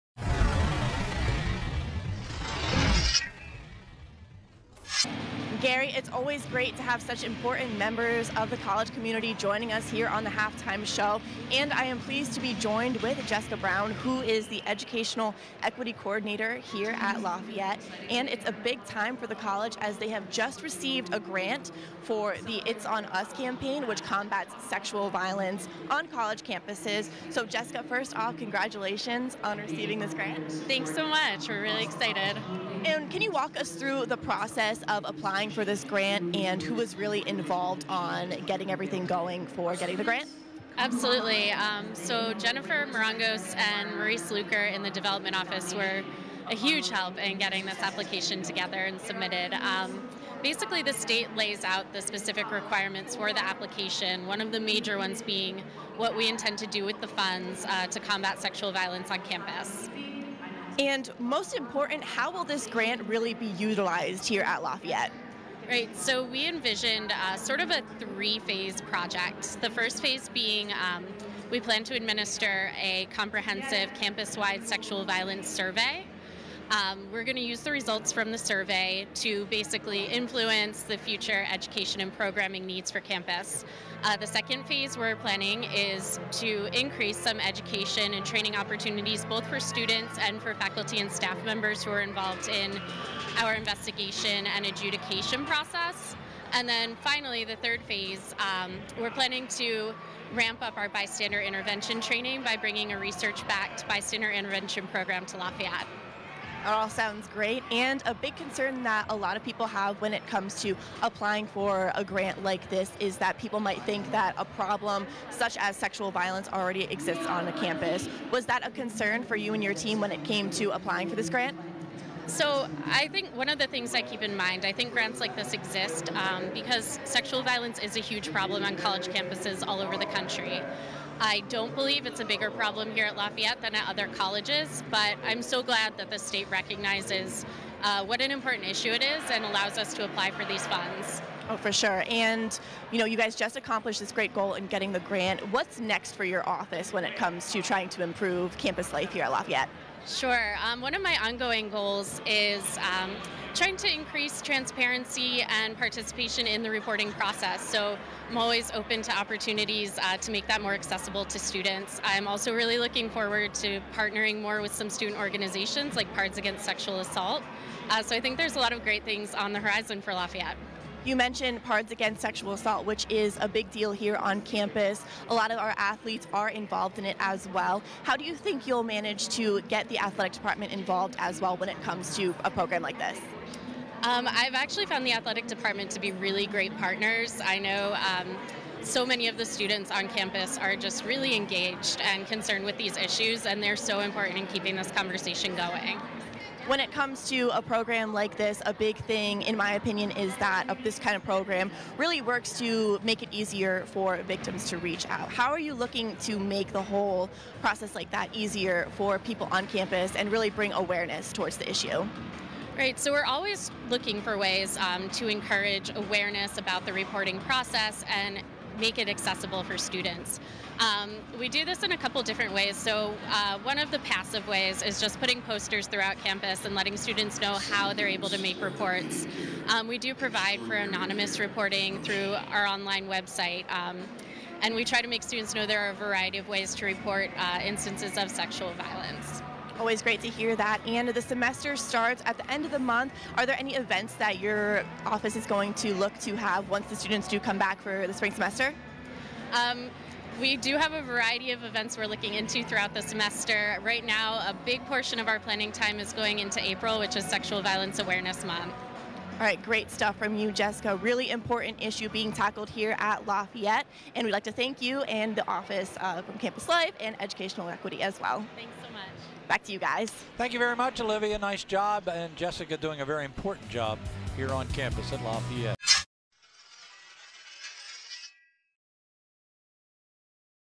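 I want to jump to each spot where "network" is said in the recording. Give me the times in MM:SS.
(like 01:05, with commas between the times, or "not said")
not said.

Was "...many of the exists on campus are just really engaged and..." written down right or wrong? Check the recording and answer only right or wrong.
wrong.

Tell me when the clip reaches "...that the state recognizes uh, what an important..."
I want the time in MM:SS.
02:15.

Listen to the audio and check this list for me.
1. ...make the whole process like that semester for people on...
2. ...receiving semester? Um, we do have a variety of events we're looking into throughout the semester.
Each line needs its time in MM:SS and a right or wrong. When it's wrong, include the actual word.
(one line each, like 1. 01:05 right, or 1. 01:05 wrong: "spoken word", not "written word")
1. 03:26 wrong: "easier", not "semester"
2. 04:08 wrong: "spring", not "receiving".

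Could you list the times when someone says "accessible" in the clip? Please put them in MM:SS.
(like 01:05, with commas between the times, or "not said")
02:40, 03:39.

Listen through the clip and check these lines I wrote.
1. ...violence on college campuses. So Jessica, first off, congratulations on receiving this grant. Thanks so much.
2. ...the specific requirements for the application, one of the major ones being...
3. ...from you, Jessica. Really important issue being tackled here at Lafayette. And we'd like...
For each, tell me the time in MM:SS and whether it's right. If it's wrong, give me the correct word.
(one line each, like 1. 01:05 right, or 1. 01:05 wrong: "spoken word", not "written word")
1. 00:25 right
2. 00:51 right
3. 04:20 right.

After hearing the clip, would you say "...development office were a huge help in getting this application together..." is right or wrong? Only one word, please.
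right.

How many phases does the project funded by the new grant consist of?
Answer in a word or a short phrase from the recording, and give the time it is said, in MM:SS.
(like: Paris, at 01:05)
3, at 01:07.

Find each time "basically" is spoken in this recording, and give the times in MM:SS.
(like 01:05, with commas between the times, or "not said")
00:50, 01:19.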